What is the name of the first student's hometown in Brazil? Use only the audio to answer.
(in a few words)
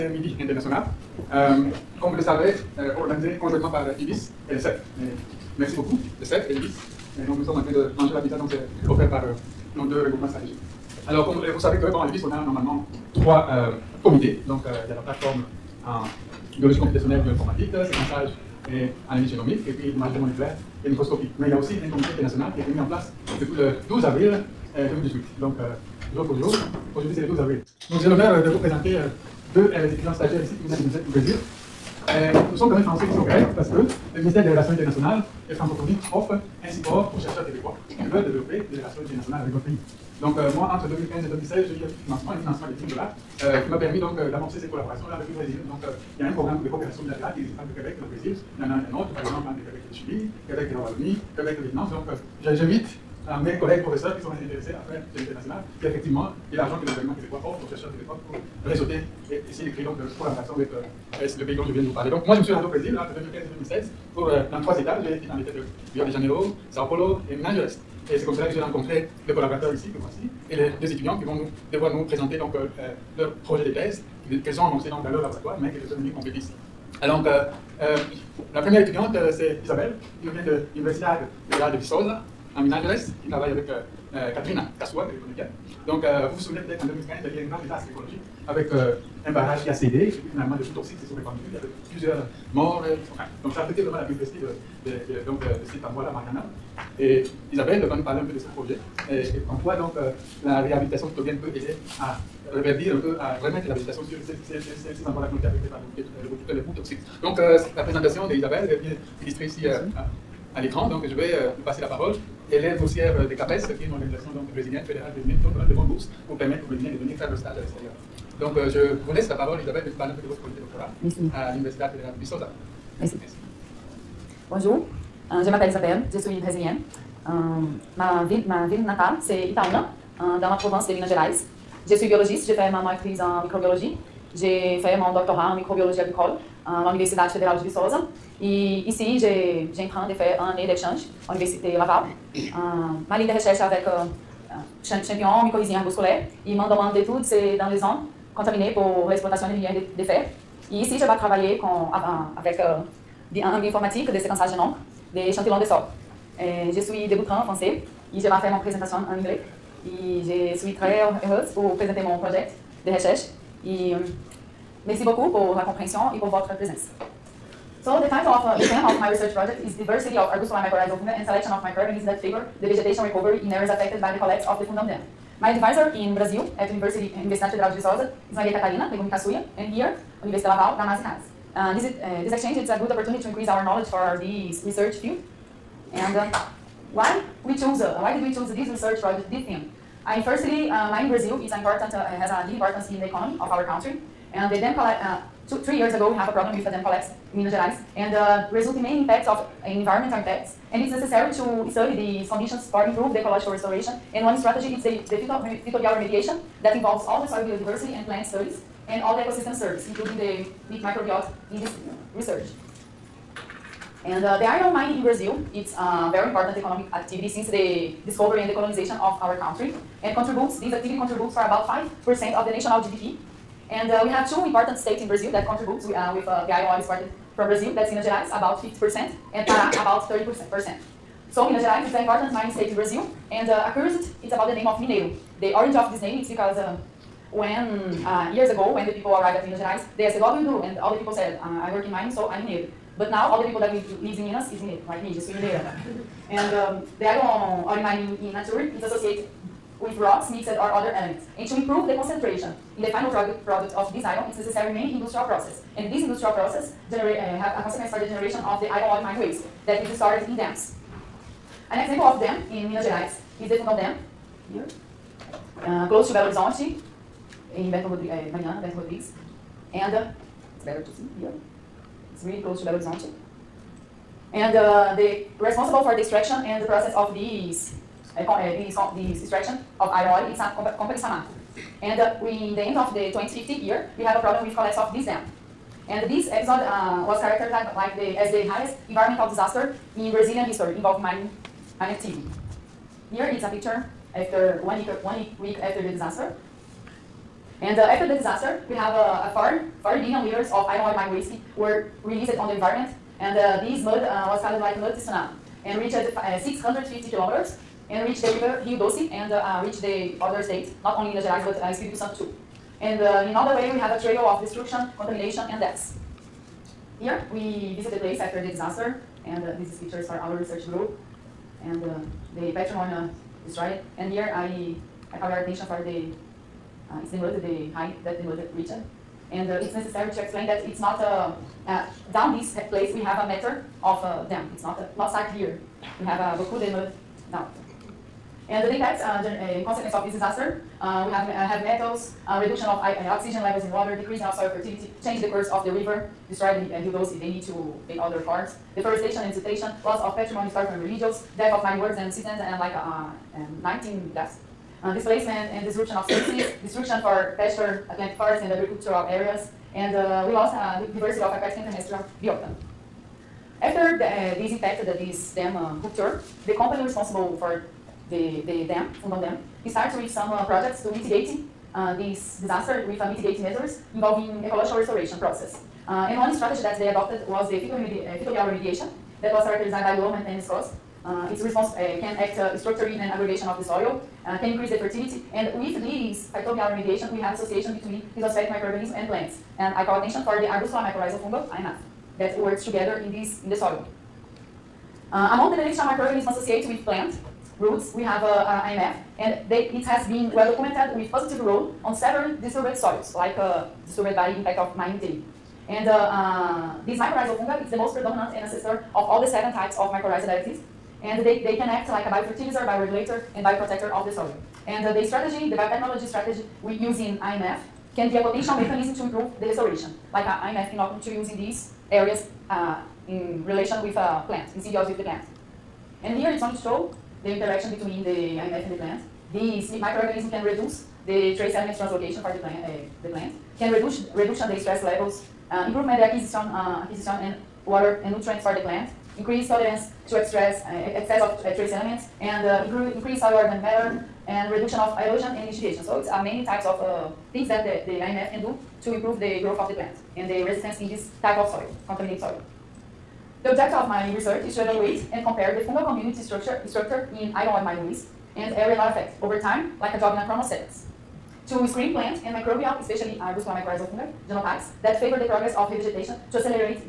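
Itaúna.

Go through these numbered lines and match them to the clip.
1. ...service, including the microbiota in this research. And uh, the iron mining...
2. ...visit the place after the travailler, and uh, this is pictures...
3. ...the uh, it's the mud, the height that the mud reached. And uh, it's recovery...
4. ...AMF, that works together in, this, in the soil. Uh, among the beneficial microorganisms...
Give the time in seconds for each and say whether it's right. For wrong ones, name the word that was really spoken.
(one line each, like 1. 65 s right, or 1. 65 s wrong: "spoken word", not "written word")
1. 209 s right
2. 317 s wrong: "disaster", not "travailler"
3. 325 s wrong: "necessary", not "recovery"
4. 391 s right.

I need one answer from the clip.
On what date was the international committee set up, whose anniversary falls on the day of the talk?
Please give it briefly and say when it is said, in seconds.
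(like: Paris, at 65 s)
12 avril 2018, at 23 s.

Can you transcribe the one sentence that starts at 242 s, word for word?
But now all the people that live, lives in Minas is it, like me, just living there.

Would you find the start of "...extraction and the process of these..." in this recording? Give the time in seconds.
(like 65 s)
276 s.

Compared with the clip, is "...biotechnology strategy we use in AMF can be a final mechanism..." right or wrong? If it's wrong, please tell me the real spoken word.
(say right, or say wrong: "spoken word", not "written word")
wrong: "potential", not "final".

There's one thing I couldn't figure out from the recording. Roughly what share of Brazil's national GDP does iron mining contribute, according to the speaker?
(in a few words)
5%.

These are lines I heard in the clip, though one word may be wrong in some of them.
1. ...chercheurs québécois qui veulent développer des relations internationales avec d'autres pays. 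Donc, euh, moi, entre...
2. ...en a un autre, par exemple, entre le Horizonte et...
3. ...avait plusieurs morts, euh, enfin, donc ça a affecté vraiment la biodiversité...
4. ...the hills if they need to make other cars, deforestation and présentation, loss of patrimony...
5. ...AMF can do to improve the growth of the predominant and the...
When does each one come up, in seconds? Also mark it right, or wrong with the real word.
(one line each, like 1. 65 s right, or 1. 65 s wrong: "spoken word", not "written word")
1. 37 s right
2. 48 s wrong: "Québec", not "Horizonte"
3. 91 s right
4. 346 s wrong: "siltation", not "présentation"
5. 447 s wrong: "plant", not "predominant".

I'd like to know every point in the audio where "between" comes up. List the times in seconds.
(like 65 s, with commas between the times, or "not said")
387 s, 427 s.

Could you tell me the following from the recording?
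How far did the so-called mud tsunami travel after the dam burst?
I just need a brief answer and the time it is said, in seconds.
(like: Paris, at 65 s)
650 kilometers, at 306 s.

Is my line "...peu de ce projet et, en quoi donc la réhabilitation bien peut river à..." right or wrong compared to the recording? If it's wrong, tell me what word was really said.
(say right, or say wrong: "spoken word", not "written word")
wrong: "aider", not "river".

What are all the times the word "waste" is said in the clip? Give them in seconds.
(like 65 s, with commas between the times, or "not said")
259 s, 301 s, 457 s.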